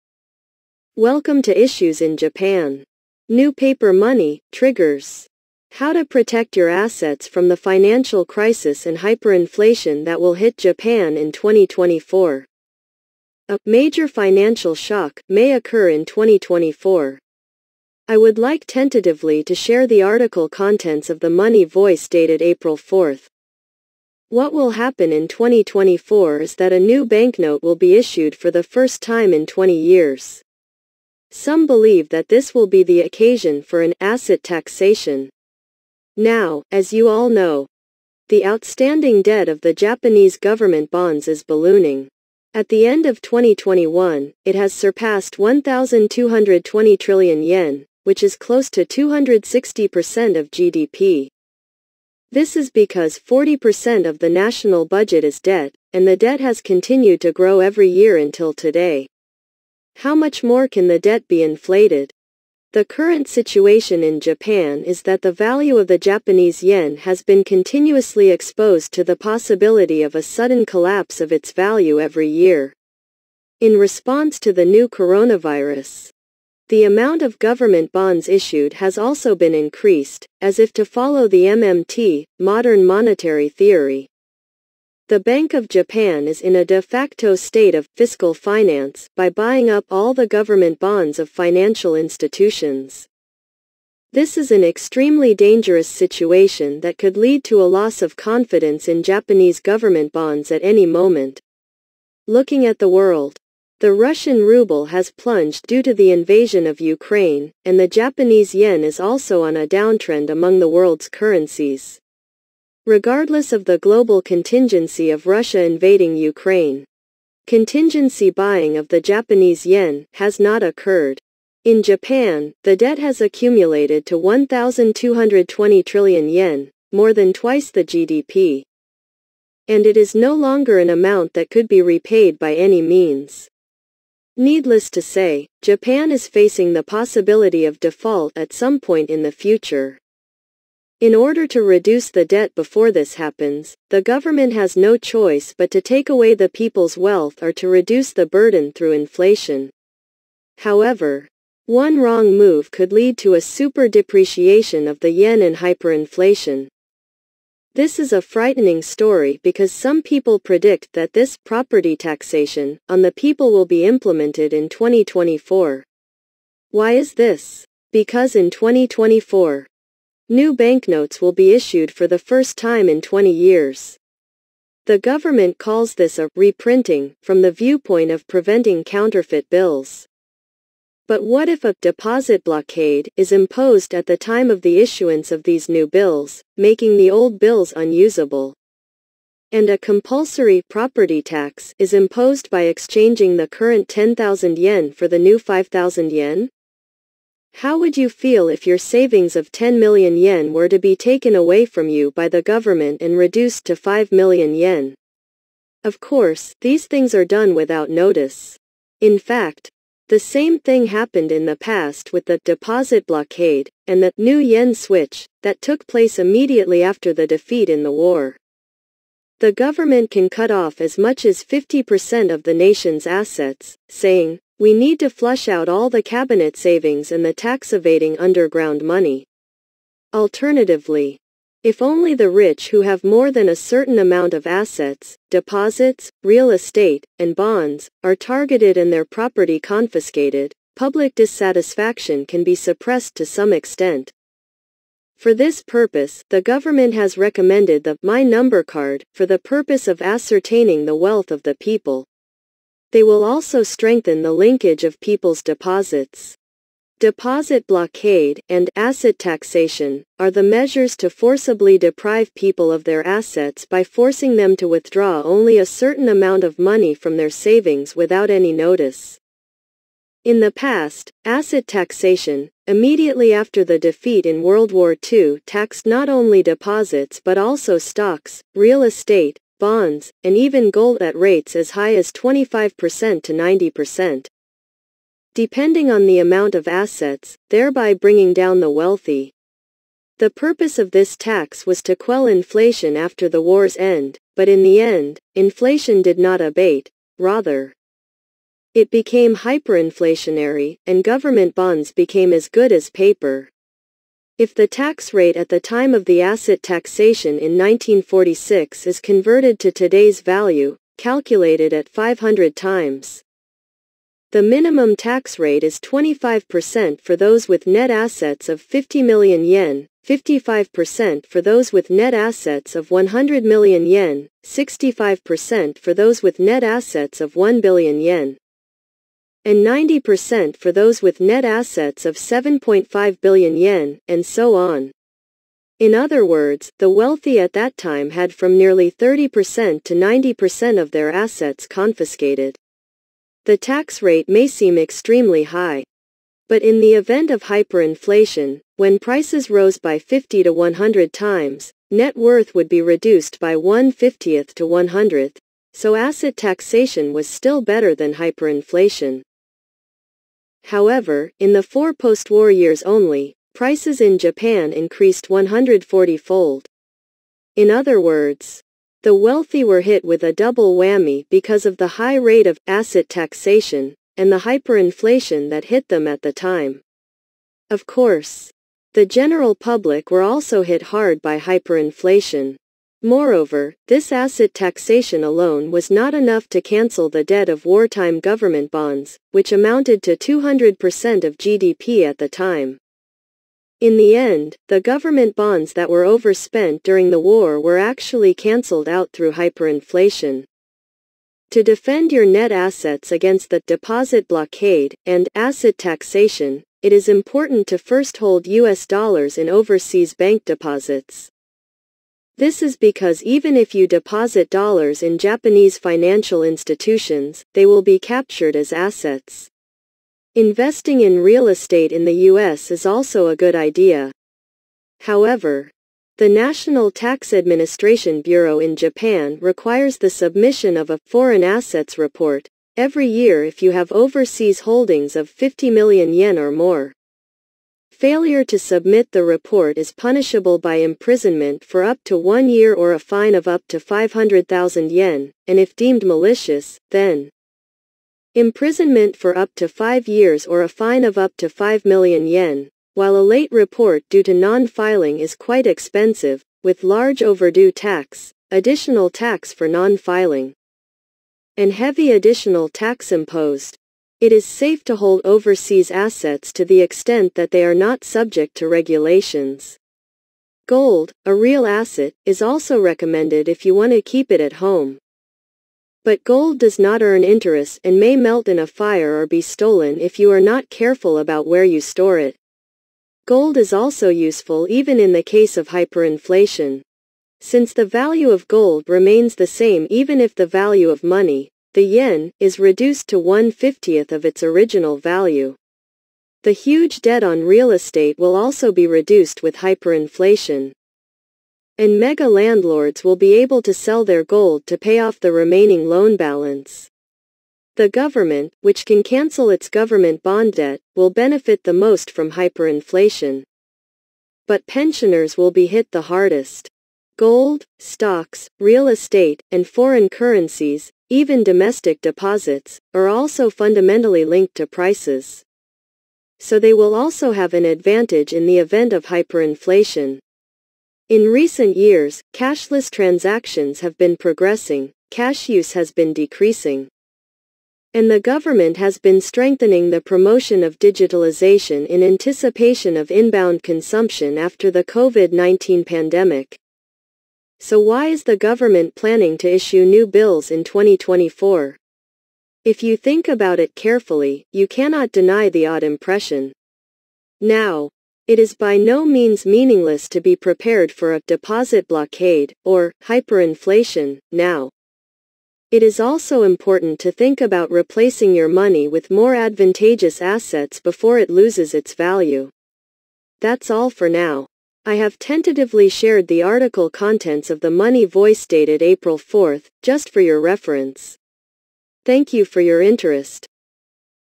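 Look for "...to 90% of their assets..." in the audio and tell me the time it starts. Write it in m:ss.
5:39.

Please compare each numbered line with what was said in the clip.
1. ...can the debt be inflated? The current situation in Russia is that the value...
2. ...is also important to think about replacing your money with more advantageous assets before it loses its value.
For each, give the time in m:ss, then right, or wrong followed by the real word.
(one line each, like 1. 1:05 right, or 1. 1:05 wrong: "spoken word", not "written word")
1. 1:00 wrong: "Japan", not "Russia"
2. 9:25 right.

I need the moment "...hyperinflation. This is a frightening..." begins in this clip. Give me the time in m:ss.
2:35.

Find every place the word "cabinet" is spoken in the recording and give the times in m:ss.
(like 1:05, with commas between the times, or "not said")
3:46.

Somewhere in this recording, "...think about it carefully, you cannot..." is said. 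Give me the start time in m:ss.
9:12.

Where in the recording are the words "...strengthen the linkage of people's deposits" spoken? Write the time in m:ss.
4:13.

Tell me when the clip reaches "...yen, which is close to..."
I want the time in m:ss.
0:47.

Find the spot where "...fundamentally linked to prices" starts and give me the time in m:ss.
8:43.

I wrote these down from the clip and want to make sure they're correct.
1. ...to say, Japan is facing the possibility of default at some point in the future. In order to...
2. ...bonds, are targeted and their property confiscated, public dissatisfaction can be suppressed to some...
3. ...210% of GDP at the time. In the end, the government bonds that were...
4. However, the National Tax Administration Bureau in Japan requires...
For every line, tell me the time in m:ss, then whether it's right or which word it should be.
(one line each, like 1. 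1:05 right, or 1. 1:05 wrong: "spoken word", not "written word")
1. 2:14 right
2. 3:57 right
3. 6:30 wrong: "200", not "210"
4. 7:05 right.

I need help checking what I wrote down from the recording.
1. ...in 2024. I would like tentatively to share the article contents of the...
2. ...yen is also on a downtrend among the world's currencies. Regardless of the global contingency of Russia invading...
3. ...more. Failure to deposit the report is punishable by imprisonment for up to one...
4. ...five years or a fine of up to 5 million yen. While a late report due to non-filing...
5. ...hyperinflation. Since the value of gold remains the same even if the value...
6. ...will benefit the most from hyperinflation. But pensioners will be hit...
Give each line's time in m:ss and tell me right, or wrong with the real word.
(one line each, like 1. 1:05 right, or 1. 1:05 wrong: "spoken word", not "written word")
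1. 0:15 right
2. 1:48 right
3. 7:16 wrong: "submit", not "deposit"
4. 7:29 right
5. 8:05 right
6. 8:30 right.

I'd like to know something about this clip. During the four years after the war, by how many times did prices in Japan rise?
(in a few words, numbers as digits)
140-fold.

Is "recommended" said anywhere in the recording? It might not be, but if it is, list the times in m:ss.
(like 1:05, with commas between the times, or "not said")
4:07, 7:52.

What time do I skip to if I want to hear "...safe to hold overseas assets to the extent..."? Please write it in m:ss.
7:44.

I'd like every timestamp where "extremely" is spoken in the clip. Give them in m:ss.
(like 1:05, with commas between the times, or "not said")
1:34, 5:44.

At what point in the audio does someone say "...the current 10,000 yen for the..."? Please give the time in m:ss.
3:13.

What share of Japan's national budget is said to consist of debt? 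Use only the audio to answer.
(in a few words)
40%.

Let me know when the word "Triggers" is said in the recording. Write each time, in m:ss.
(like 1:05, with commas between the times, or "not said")
0:04.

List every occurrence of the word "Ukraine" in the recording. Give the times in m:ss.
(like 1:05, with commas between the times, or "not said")
1:46, 1:56.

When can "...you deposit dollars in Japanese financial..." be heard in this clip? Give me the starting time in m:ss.
6:53.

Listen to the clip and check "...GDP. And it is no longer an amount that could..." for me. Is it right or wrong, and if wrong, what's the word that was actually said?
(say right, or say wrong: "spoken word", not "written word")
right.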